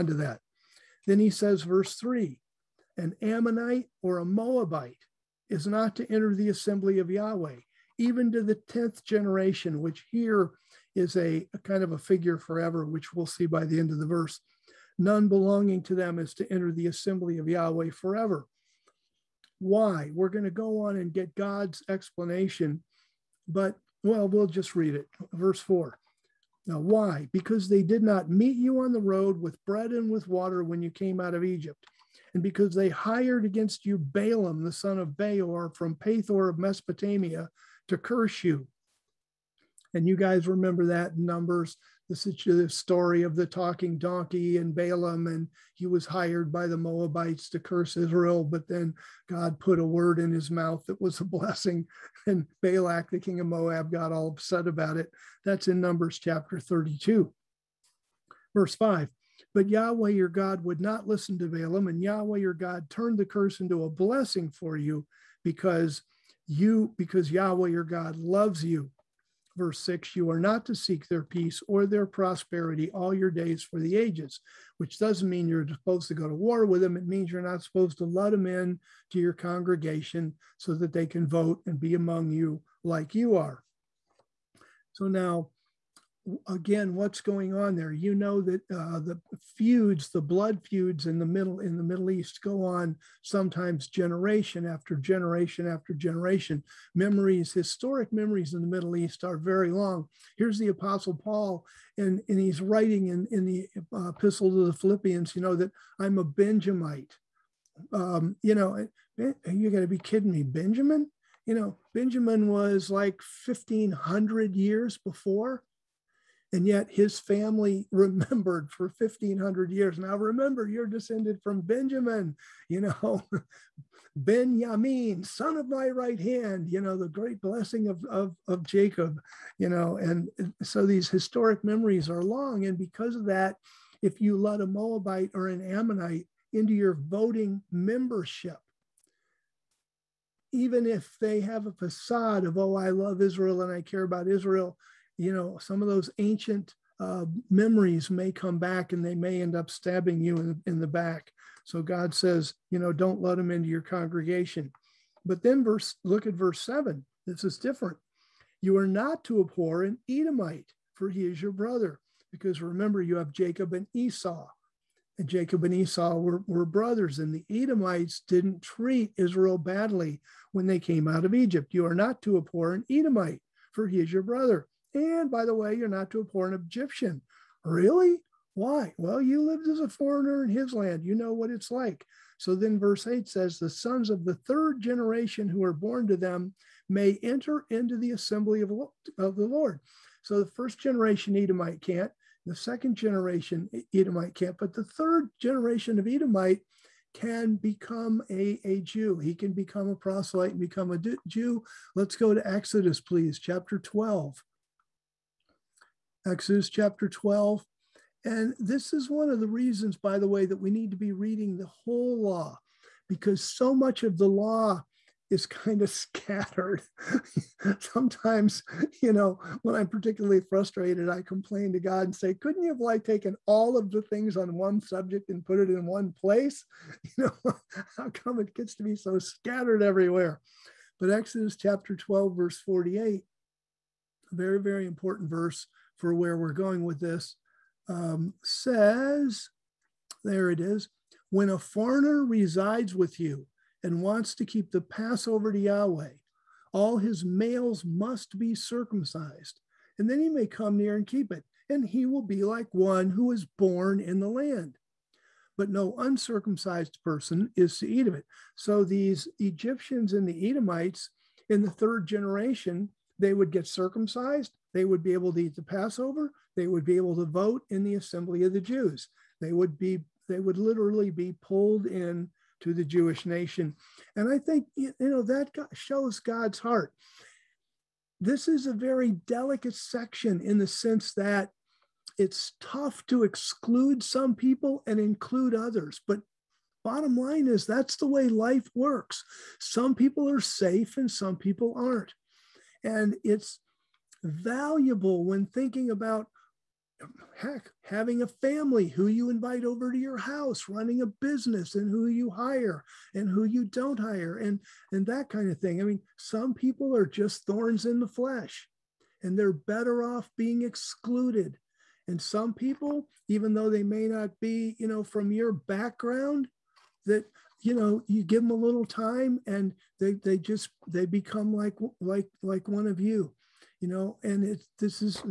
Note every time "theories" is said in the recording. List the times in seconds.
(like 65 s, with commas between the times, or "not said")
not said.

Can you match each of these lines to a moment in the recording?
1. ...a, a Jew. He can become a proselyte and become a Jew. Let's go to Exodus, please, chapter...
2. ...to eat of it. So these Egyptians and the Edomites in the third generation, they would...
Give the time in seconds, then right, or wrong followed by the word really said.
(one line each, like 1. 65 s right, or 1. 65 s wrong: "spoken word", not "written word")
1. 198 s right
2. 257 s right.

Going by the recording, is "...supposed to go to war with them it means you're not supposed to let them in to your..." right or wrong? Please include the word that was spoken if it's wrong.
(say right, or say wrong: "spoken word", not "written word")
right.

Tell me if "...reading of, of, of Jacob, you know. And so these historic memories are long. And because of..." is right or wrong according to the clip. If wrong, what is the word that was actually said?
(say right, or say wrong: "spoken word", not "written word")
wrong: "blessing", not "reading".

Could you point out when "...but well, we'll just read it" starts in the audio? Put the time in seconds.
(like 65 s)
23 s.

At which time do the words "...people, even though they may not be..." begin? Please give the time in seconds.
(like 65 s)
312 s.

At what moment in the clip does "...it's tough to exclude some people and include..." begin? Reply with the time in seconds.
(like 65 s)
282 s.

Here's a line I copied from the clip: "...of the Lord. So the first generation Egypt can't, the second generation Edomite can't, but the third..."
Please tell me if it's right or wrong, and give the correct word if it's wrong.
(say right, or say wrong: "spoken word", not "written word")
wrong: "Edomite", not "Egypt".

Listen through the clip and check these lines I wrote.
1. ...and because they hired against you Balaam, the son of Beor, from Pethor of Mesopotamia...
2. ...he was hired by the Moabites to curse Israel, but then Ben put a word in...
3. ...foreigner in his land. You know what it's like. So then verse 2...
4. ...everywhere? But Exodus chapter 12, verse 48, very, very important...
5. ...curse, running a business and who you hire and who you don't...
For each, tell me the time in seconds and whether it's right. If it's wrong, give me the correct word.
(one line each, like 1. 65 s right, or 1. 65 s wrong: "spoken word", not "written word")
1. 32 s right
2. 45 s wrong: "God", not "Ben"
3. 179 s wrong: "8", not "2"
4. 229 s right
5. 300 s wrong: "house", not "curse".